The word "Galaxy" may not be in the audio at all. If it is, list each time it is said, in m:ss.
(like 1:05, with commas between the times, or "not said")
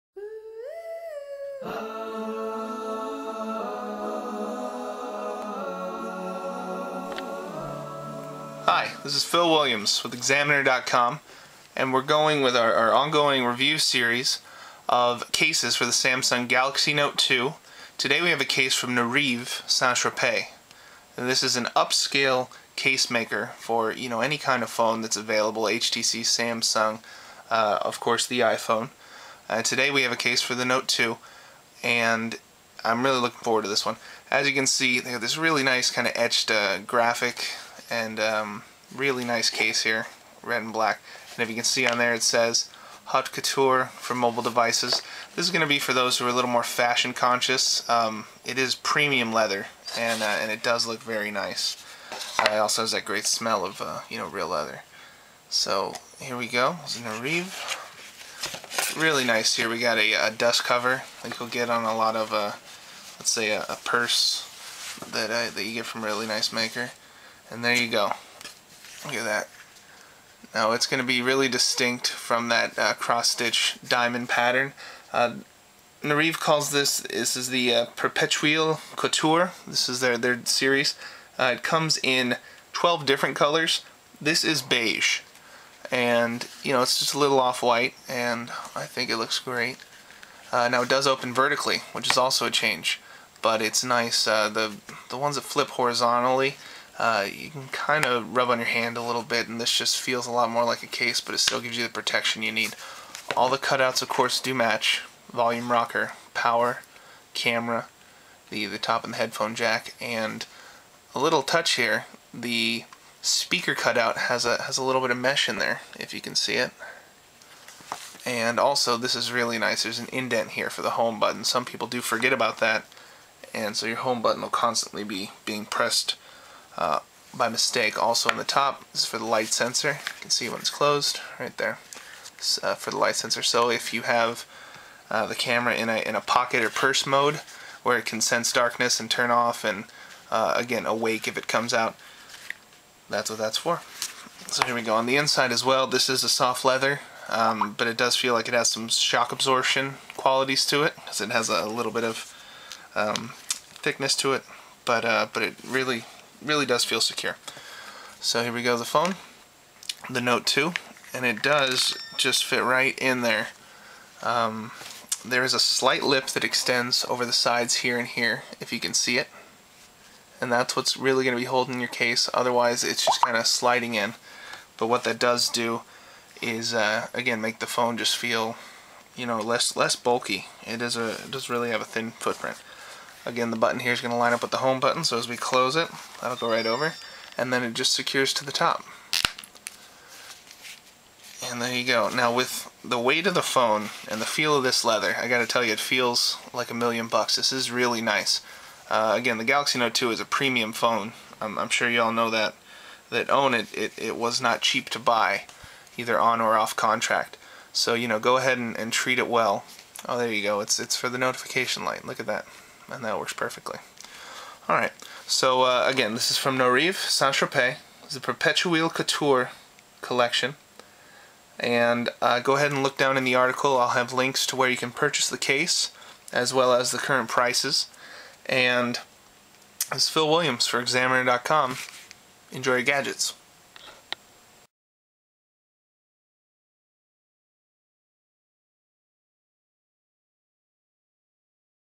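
0:16, 3:19.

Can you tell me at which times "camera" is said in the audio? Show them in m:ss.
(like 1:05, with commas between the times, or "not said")
1:47, 2:15.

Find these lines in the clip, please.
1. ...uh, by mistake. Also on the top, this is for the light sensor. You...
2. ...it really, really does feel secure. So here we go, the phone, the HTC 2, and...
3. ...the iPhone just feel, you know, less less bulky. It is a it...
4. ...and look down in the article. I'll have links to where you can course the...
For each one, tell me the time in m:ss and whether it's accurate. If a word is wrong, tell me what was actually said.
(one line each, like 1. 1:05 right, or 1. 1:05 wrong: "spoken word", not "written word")
1. 2:06 right
2. 2:35 wrong: "Note", not "HTC"
3. 2:57 wrong: "phone", not "iPhone"
4. 3:42 wrong: "purchase", not "course".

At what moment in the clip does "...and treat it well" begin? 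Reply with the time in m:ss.
3:28.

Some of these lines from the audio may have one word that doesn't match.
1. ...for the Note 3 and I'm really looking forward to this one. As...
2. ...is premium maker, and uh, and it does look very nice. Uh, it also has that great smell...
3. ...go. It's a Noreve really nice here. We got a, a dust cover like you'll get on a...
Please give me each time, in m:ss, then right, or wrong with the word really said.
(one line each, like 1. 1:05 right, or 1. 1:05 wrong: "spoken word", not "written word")
1. 0:30 wrong: "2", not "3"
2. 0:48 wrong: "leather", not "maker"
3. 0:56 right.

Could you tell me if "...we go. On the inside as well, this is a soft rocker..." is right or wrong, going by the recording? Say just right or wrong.
wrong.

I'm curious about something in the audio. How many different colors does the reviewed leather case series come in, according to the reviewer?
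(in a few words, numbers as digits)
12.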